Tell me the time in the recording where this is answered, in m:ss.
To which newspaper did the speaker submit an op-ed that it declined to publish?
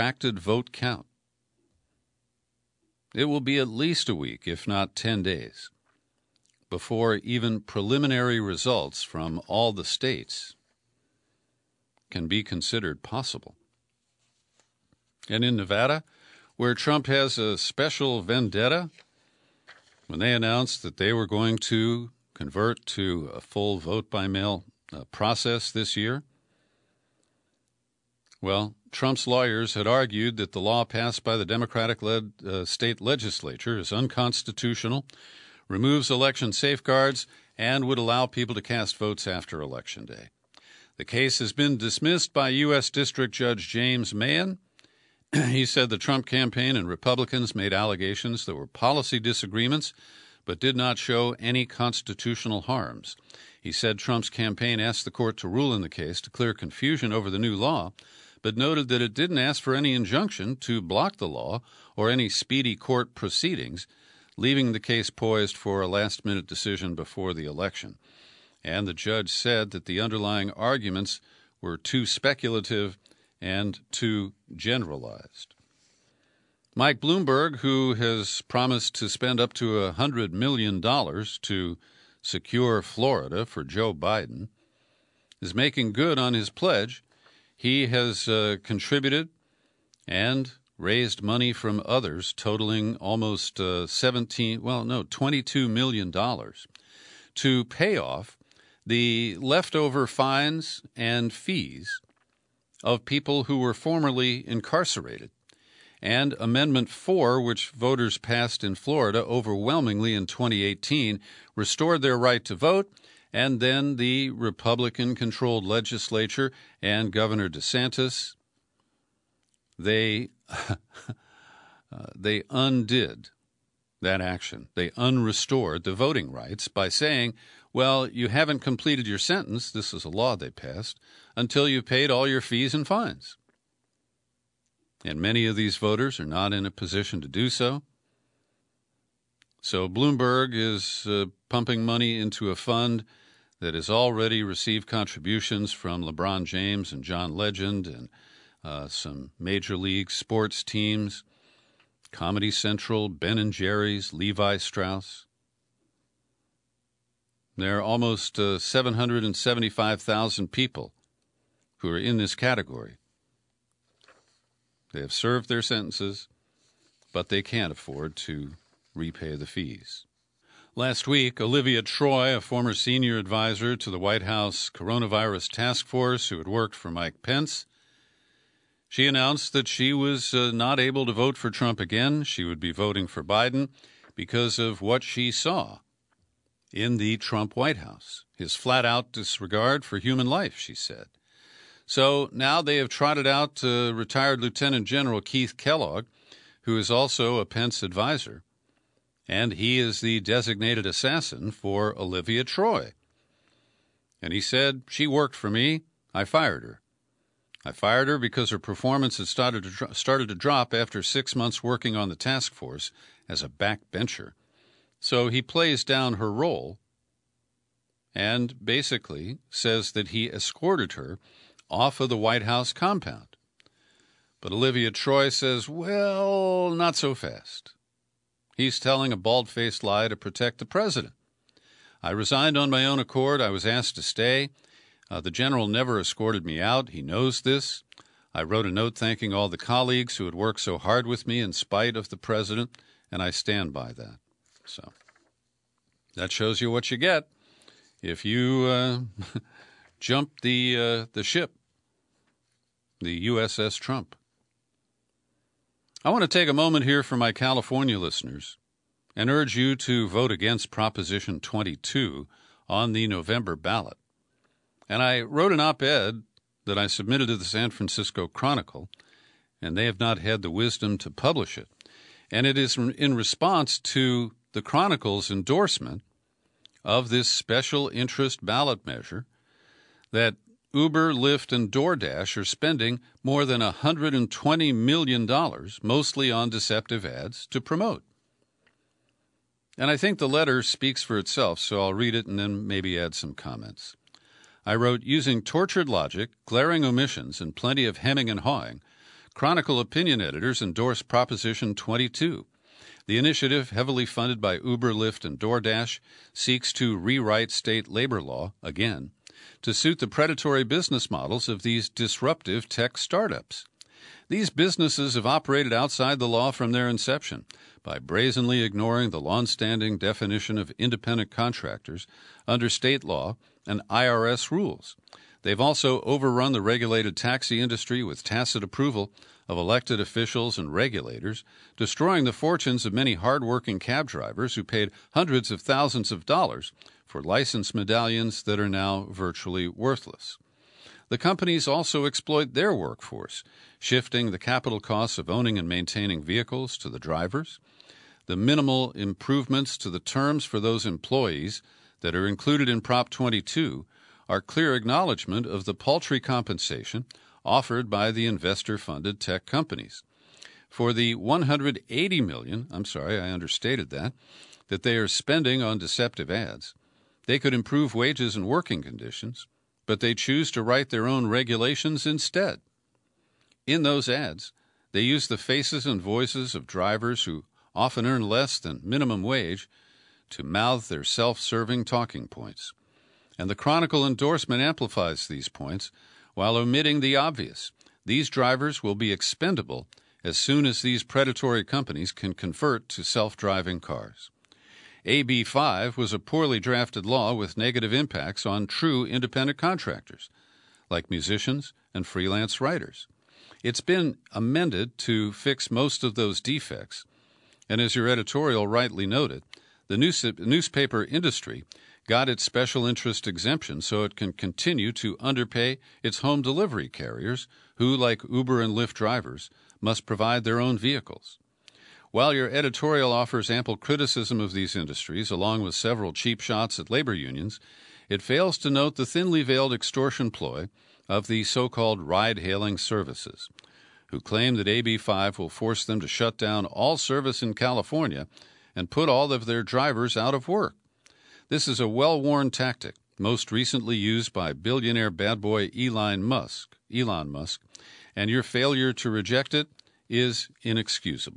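4:27.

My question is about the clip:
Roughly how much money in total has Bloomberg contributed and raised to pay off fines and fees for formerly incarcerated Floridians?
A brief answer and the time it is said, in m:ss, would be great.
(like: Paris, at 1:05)
$22 million, at 1:35.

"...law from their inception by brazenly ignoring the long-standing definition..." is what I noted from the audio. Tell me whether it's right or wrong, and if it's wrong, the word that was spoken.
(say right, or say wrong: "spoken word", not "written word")
right.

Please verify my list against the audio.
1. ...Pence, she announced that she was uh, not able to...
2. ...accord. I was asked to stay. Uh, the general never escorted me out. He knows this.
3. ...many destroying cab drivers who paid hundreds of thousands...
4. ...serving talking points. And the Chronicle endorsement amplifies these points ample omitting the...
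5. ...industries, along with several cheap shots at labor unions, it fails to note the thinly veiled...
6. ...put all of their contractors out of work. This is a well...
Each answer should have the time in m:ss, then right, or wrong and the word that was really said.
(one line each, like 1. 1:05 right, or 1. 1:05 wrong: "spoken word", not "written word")
1. 2:57 right
2. 3:52 right
3. 5:32 wrong: "hardworking", not "destroying"
4. 6:21 wrong: "while", not "ample"
5. 7:04 right
6. 7:18 wrong: "drivers", not "contractors".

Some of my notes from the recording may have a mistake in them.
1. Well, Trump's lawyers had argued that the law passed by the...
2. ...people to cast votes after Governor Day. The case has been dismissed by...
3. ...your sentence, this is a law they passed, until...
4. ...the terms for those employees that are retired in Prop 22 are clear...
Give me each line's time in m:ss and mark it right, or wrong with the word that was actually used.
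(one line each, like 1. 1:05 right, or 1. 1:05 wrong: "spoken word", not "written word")
1. 0:28 right
2. 0:38 wrong: "Election", not "Governor"
3. 2:09 right
4. 5:49 wrong: "included", not "retired".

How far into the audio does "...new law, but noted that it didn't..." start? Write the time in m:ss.
0:57.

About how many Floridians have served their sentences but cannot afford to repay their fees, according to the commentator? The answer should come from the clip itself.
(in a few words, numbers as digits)
775,000.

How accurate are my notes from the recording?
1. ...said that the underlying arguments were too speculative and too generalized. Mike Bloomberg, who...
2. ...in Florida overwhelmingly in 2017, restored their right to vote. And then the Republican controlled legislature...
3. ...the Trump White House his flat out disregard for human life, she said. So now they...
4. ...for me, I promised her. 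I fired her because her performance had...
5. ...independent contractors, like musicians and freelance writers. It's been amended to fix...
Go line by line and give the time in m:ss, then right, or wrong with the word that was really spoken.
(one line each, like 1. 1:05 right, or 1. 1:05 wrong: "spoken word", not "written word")
1. 1:09 right
2. 1:48 wrong: "2018", not "2017"
3. 3:06 right
4. 3:25 wrong: "fired", not "promised"
5. 6:39 right.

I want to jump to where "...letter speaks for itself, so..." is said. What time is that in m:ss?
4:50.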